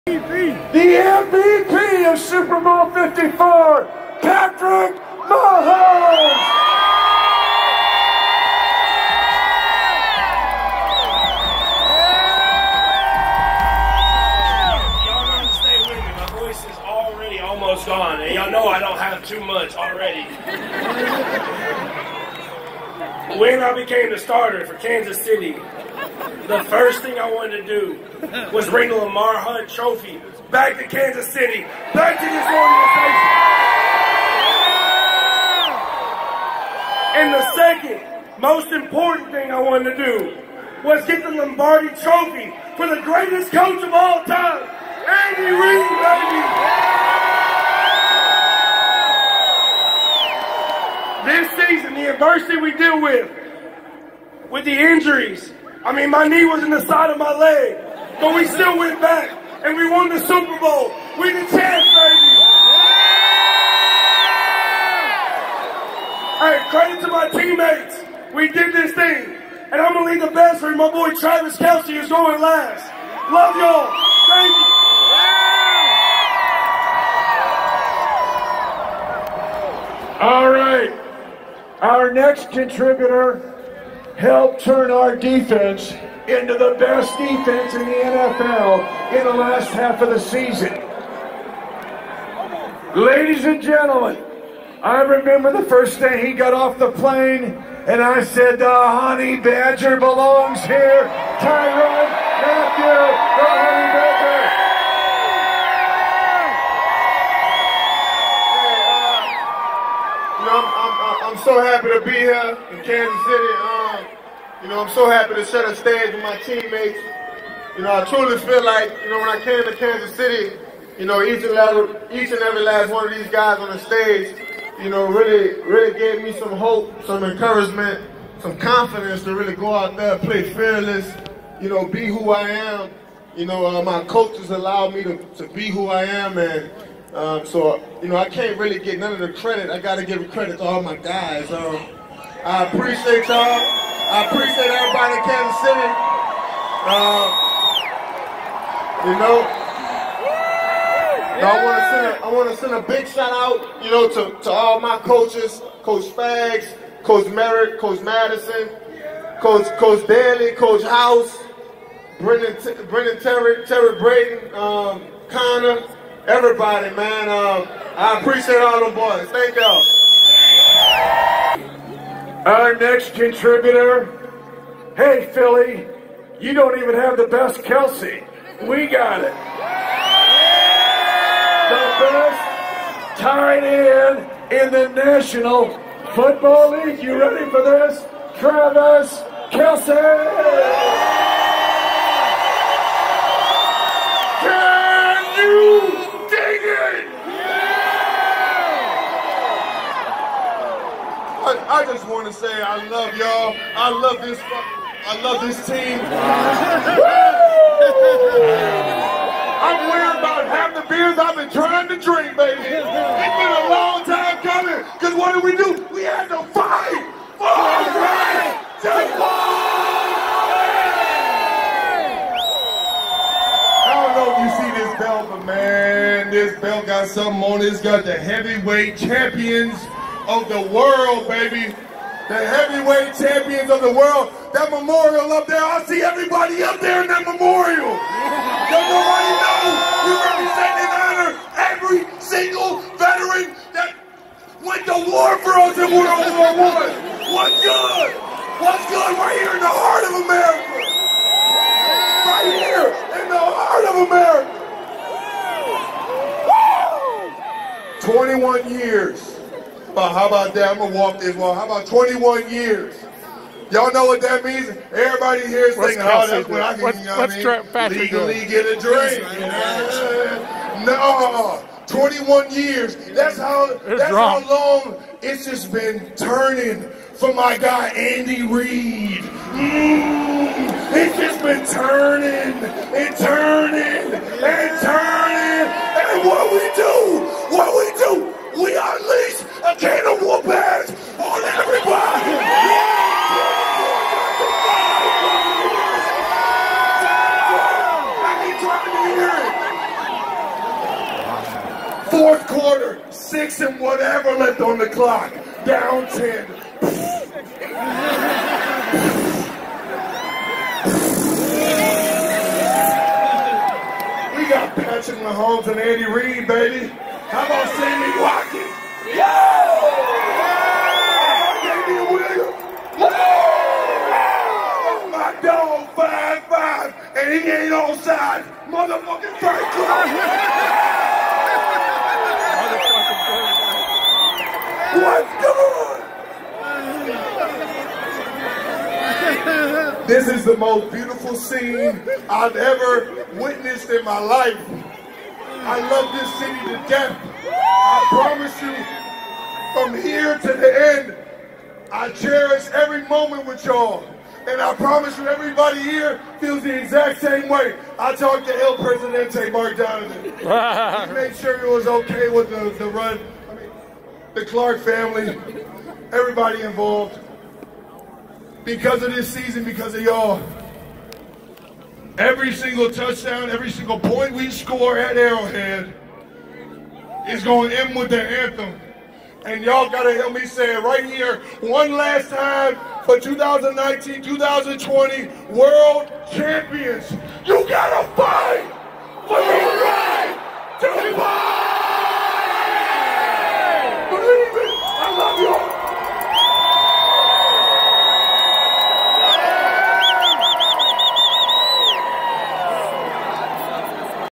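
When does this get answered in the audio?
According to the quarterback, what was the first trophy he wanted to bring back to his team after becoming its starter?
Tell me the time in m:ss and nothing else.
0:28.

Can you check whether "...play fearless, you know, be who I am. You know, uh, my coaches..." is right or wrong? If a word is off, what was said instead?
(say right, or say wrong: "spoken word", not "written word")
right.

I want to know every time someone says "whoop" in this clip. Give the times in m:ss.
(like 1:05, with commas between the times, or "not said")
4:50.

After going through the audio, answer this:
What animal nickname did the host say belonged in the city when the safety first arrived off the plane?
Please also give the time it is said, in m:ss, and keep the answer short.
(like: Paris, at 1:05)
honey badger, at 1:38.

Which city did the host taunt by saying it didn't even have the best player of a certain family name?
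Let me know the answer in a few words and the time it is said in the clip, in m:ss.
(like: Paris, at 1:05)
Philly, at 2:55.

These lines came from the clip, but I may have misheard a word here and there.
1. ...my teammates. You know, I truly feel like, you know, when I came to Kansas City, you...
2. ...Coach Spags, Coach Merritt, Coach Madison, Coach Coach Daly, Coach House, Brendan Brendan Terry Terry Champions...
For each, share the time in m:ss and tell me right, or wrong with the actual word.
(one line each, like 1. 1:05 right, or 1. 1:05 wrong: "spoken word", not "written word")
1. 1:56 right
2. 2:35 wrong: "Brayton", not "Champions".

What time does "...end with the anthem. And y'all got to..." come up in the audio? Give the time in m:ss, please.
6:17.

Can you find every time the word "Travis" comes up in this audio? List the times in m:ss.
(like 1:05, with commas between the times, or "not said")
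1:11, 3:08.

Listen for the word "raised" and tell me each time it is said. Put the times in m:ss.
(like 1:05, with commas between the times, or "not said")
not said.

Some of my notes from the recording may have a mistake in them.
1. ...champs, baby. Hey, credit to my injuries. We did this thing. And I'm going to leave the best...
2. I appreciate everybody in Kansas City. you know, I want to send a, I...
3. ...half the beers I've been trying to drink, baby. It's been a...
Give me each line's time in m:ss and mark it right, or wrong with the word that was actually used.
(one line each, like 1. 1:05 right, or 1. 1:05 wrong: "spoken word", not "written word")
1. 1:01 wrong: "teammates", not "injuries"
2. 2:24 right
3. 3:30 right.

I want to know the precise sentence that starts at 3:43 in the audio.
I don't know if you see this belt, but man, this belt got something on it.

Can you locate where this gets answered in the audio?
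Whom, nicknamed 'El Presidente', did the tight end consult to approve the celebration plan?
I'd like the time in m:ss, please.
5:59.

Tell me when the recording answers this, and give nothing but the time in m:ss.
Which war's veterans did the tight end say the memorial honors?
4:05.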